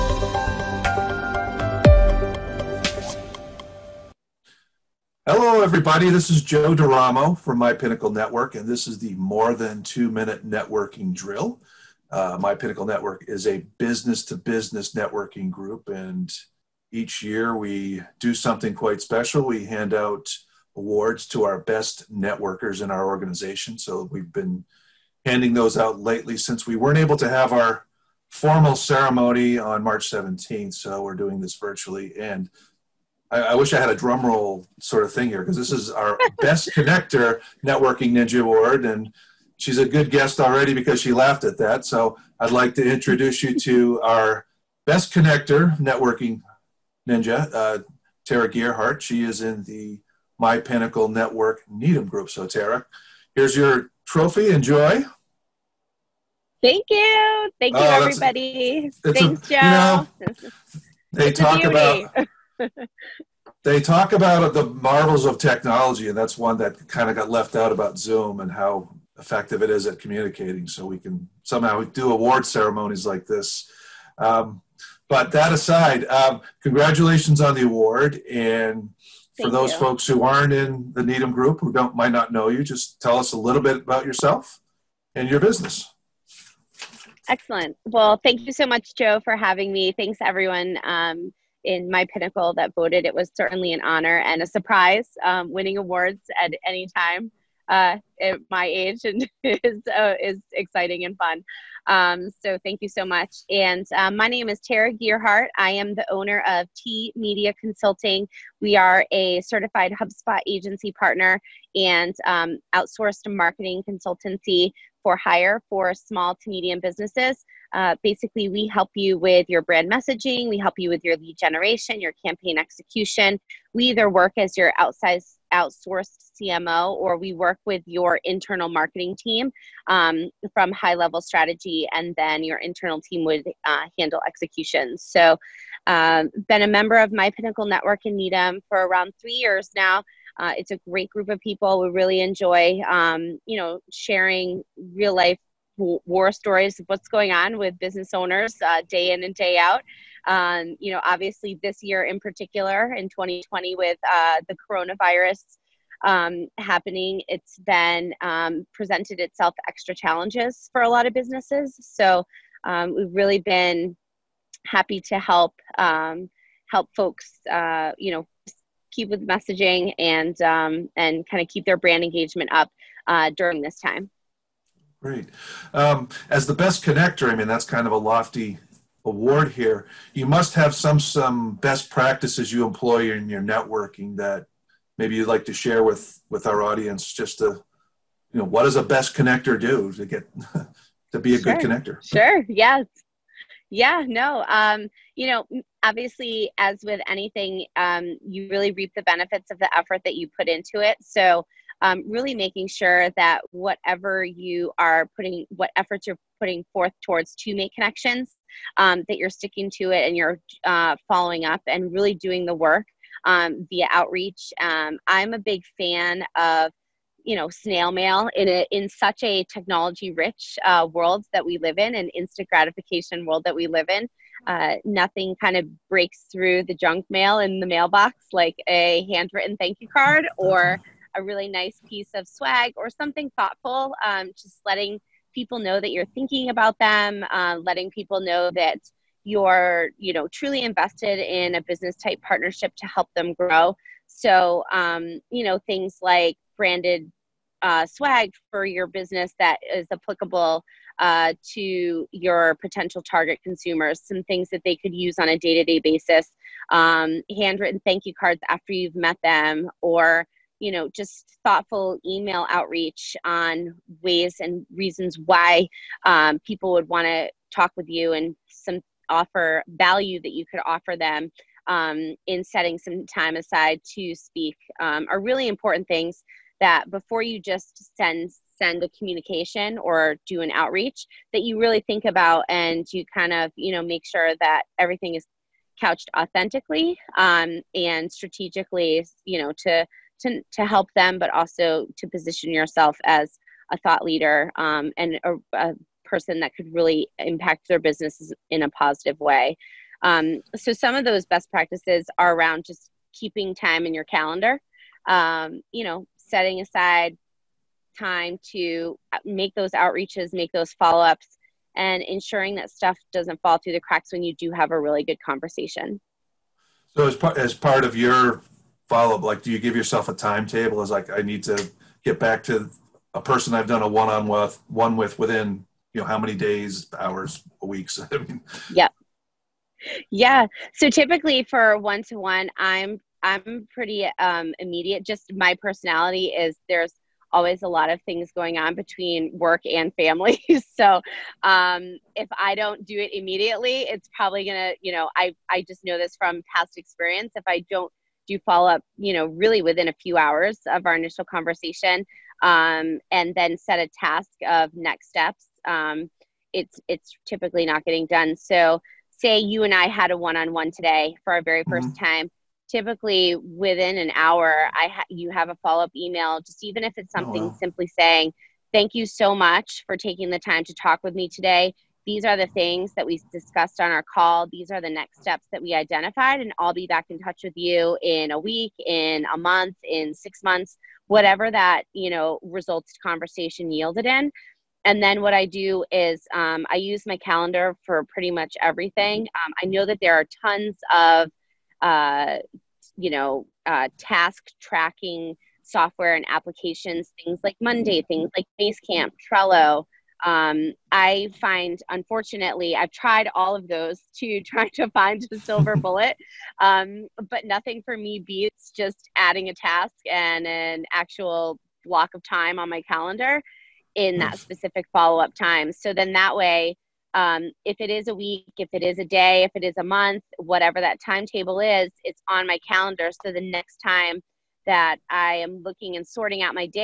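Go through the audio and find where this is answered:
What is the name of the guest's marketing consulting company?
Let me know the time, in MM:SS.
01:46.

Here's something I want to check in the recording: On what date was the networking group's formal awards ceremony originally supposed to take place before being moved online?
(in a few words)
March 17th.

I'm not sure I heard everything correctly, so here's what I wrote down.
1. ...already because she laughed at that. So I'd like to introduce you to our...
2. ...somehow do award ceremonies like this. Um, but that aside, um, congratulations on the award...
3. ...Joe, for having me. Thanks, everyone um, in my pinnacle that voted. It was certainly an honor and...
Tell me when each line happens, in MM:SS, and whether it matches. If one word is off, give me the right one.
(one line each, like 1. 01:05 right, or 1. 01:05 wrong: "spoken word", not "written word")
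1. 00:40 right
2. 01:11 right
3. 01:28 right.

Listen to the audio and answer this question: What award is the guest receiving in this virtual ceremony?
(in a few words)
Best connector networking ninja award.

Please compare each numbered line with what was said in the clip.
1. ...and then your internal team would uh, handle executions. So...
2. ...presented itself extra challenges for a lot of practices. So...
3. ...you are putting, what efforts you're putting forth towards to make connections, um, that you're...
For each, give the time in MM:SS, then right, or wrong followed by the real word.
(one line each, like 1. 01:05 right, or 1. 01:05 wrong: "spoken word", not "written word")
1. 02:11 right
2. 02:38 wrong: "businesses", not "practices"
3. 03:24 right.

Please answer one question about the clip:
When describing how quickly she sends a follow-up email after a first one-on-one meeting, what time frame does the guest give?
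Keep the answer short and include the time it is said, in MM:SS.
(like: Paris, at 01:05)
Within an hour, at 06:03.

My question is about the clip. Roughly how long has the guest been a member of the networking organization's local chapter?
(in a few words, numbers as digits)
3 years.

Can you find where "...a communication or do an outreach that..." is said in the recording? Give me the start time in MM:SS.
04:38.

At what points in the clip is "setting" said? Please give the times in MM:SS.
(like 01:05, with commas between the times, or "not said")
04:32, 05:06.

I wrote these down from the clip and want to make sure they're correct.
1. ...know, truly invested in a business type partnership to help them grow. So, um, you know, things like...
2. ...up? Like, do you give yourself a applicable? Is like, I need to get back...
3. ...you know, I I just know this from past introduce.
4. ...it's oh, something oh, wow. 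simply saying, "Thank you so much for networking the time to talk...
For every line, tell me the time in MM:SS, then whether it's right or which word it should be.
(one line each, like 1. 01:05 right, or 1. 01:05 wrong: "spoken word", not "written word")
1. 04:00 right
2. 05:19 wrong: "timetable", not "applicable"
3. 05:44 wrong: "experience", not "introduce"
4. 06:06 wrong: "taking", not "networking".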